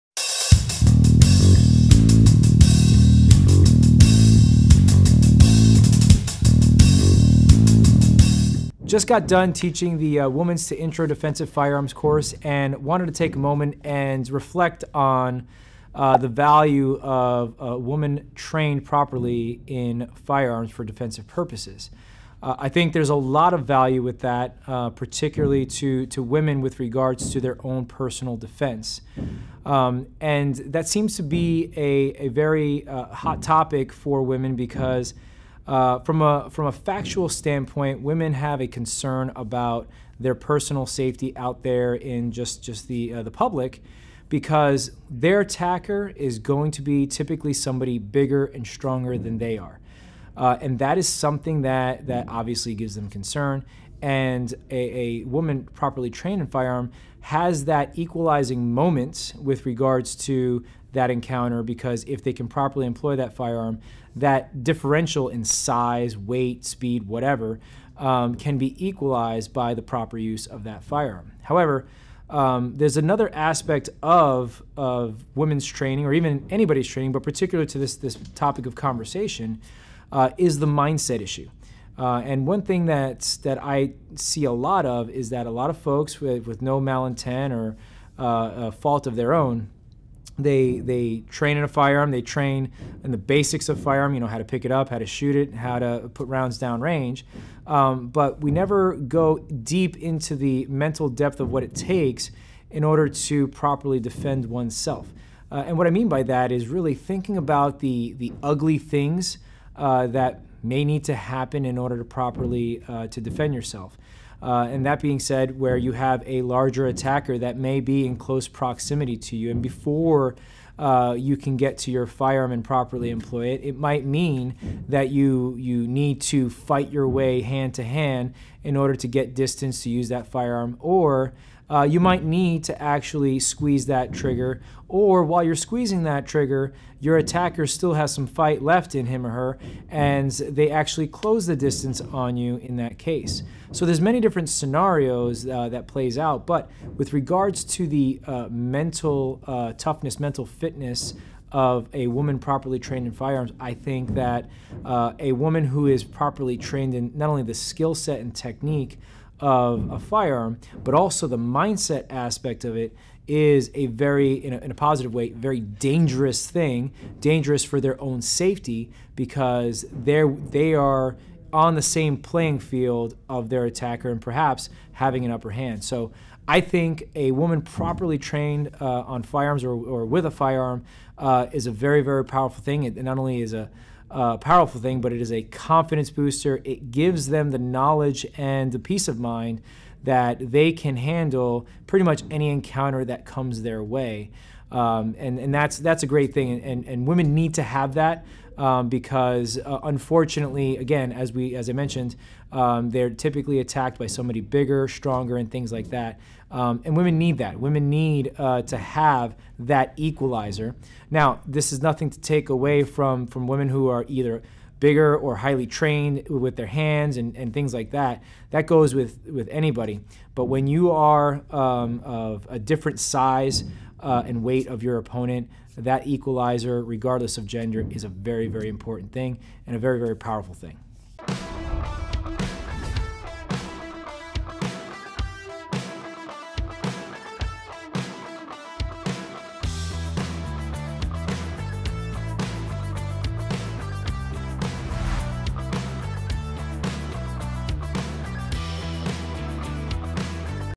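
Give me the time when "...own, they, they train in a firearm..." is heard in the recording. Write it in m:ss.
1:29.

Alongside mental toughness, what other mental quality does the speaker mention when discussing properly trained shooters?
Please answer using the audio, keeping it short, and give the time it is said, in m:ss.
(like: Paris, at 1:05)
mental fitness, at 2:30.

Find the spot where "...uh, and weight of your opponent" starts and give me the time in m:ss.
3:44.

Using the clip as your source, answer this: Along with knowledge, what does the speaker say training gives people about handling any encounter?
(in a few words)
peace of mind.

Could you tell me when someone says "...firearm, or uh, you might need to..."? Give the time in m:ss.
2:10.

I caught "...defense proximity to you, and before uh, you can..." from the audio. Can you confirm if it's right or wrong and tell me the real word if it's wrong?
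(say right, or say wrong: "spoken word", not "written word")
wrong: "close", not "defense".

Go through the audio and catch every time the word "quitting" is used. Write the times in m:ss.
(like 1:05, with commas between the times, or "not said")
not said.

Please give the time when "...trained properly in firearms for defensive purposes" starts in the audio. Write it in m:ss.
0:18.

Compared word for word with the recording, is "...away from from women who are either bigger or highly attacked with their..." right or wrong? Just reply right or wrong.
wrong.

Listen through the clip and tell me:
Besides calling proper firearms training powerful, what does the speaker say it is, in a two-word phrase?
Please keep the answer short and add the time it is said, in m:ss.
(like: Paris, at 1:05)
confidence booster, at 3:05.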